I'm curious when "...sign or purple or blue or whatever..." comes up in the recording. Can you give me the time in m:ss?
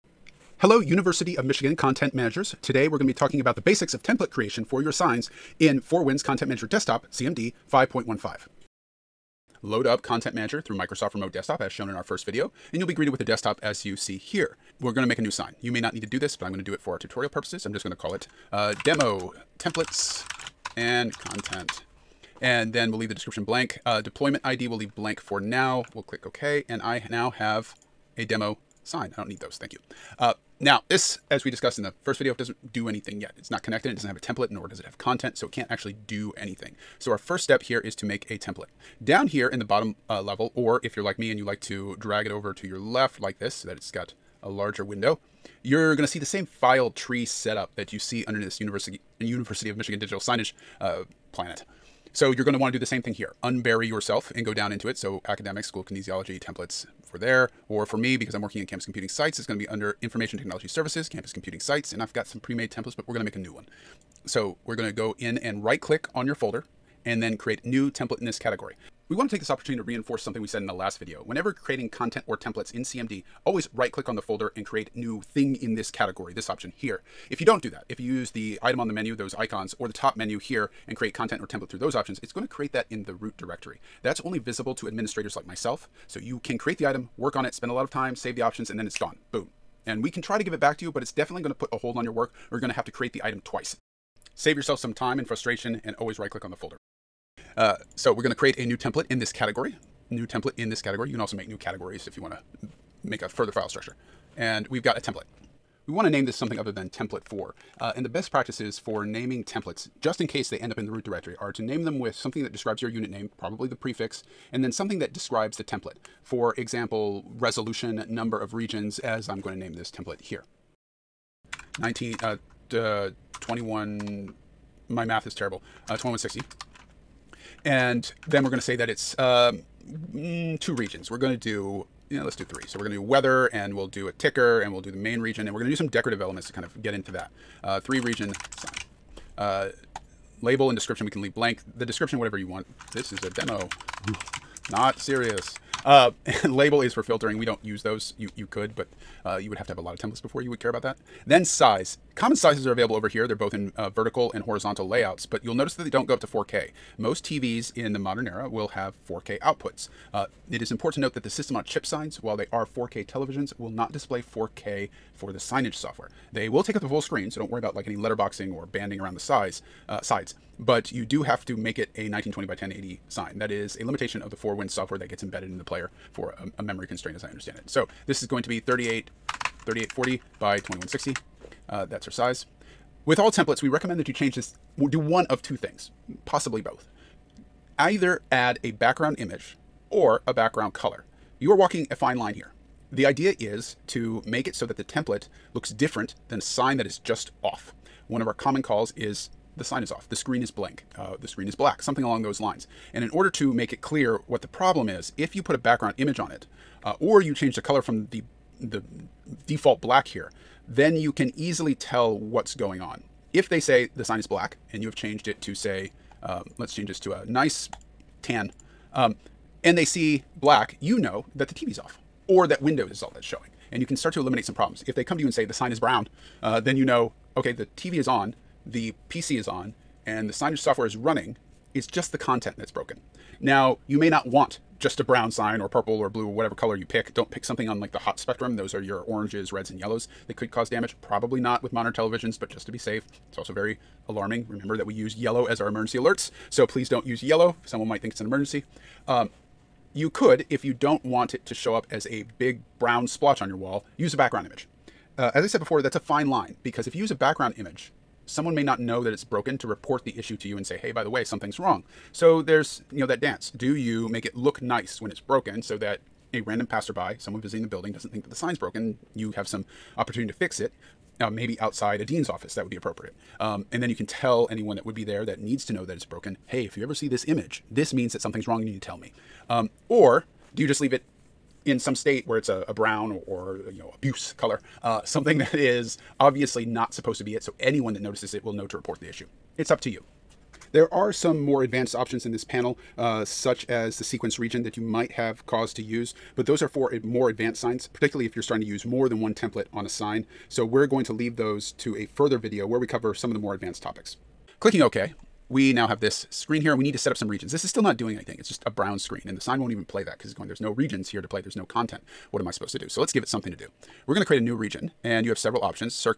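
3:55.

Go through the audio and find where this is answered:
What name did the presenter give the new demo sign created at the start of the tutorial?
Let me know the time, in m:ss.
0:18.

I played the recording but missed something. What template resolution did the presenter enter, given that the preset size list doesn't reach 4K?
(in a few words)
3840 by 2160.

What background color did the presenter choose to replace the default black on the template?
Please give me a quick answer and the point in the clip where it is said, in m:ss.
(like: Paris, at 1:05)
tan, at 3:37.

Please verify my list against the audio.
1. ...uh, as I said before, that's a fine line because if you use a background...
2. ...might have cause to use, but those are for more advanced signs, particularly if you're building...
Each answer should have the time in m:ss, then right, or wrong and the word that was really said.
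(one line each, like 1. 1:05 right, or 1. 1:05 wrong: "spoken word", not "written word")
1. 4:15 right
2. 4:54 wrong: "starting", not "building".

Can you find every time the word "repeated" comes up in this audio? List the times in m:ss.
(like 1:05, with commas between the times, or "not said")
not said.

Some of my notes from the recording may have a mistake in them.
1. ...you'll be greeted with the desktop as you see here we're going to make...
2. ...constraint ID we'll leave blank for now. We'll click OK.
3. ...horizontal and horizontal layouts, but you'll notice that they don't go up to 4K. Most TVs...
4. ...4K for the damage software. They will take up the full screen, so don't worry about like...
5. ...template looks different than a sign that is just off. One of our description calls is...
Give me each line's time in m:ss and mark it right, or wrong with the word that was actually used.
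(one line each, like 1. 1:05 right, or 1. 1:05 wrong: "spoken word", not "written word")
1. 0:12 right
2. 0:23 wrong: "deployment", not "constraint"
3. 2:33 wrong: "vertical", not "horizontal"
4. 2:44 wrong: "signage", not "damage"
5. 3:14 wrong: "common", not "description".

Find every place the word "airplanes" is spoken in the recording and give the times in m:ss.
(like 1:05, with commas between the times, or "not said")
not said.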